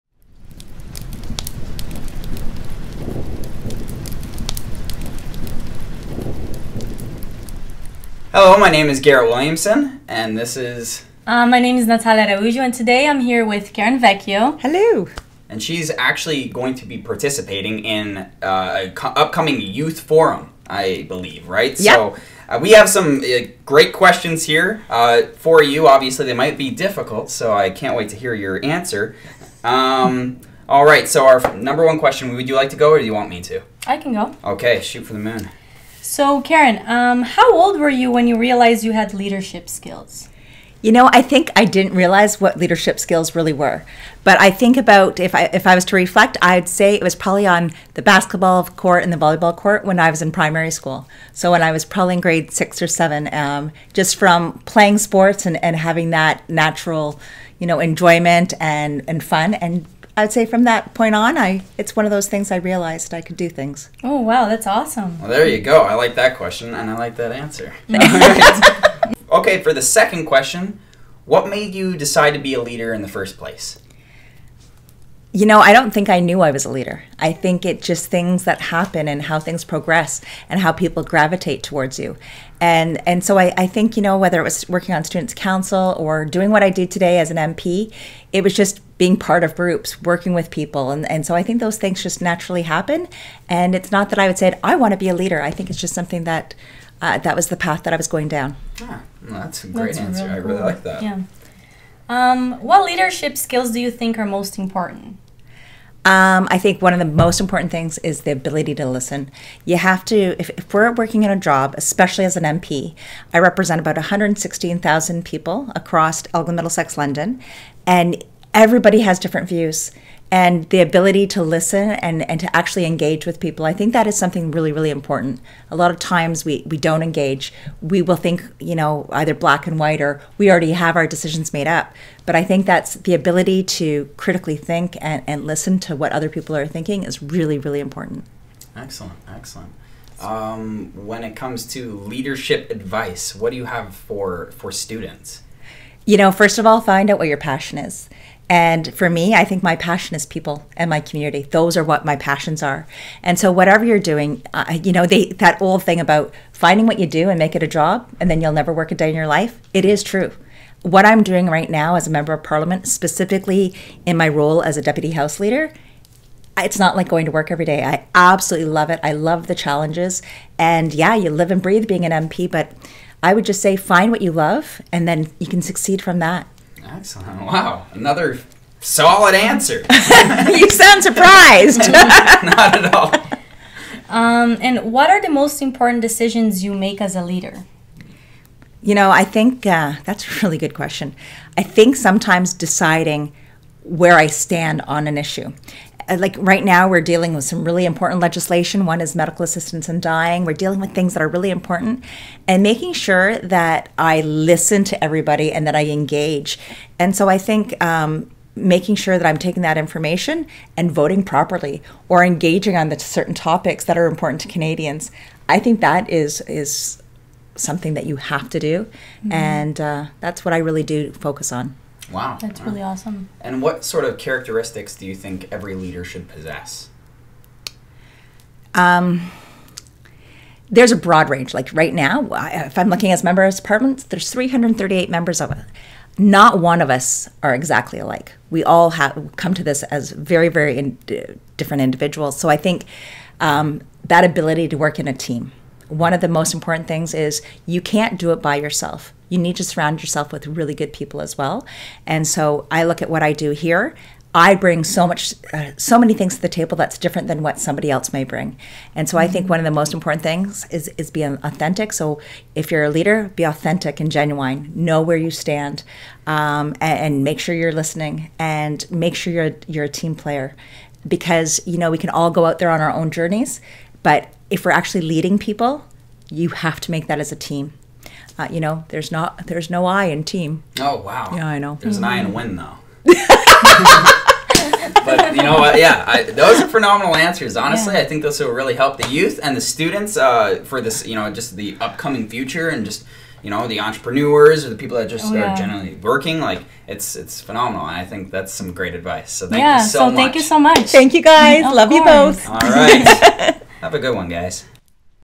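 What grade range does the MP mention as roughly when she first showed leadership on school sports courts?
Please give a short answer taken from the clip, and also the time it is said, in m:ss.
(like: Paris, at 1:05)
grade 6 or 7, at 0:52.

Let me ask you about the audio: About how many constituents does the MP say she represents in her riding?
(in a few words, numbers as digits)
116,000.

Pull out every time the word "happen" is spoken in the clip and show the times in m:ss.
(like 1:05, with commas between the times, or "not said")
1:18, 1:32.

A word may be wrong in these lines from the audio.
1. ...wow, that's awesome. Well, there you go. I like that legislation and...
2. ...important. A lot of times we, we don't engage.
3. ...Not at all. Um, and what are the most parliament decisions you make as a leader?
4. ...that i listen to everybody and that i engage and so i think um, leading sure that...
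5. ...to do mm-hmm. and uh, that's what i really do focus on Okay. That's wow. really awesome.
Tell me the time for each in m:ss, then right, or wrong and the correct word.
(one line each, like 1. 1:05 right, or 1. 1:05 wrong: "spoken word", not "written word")
1. 1:04 wrong: "question", not "legislation"
2. 2:04 right
3. 3:01 wrong: "important", not "parliament"
4. 3:23 wrong: "making", not "leading"
5. 3:38 wrong: "Wow", not "Okay".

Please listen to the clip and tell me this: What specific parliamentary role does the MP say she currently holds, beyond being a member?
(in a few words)
deputy house leader.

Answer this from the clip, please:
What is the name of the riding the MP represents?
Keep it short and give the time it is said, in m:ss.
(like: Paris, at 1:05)
Elgin Middlesex London, at 1:56.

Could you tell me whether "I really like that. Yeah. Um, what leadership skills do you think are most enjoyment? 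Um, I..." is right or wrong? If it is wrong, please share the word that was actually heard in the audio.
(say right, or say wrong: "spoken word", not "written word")
wrong: "important", not "enjoyment".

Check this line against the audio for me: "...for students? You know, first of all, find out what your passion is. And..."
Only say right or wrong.
right.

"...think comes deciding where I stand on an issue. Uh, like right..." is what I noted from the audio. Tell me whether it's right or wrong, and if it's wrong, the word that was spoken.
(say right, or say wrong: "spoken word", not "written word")
wrong: "sometimes", not "comes".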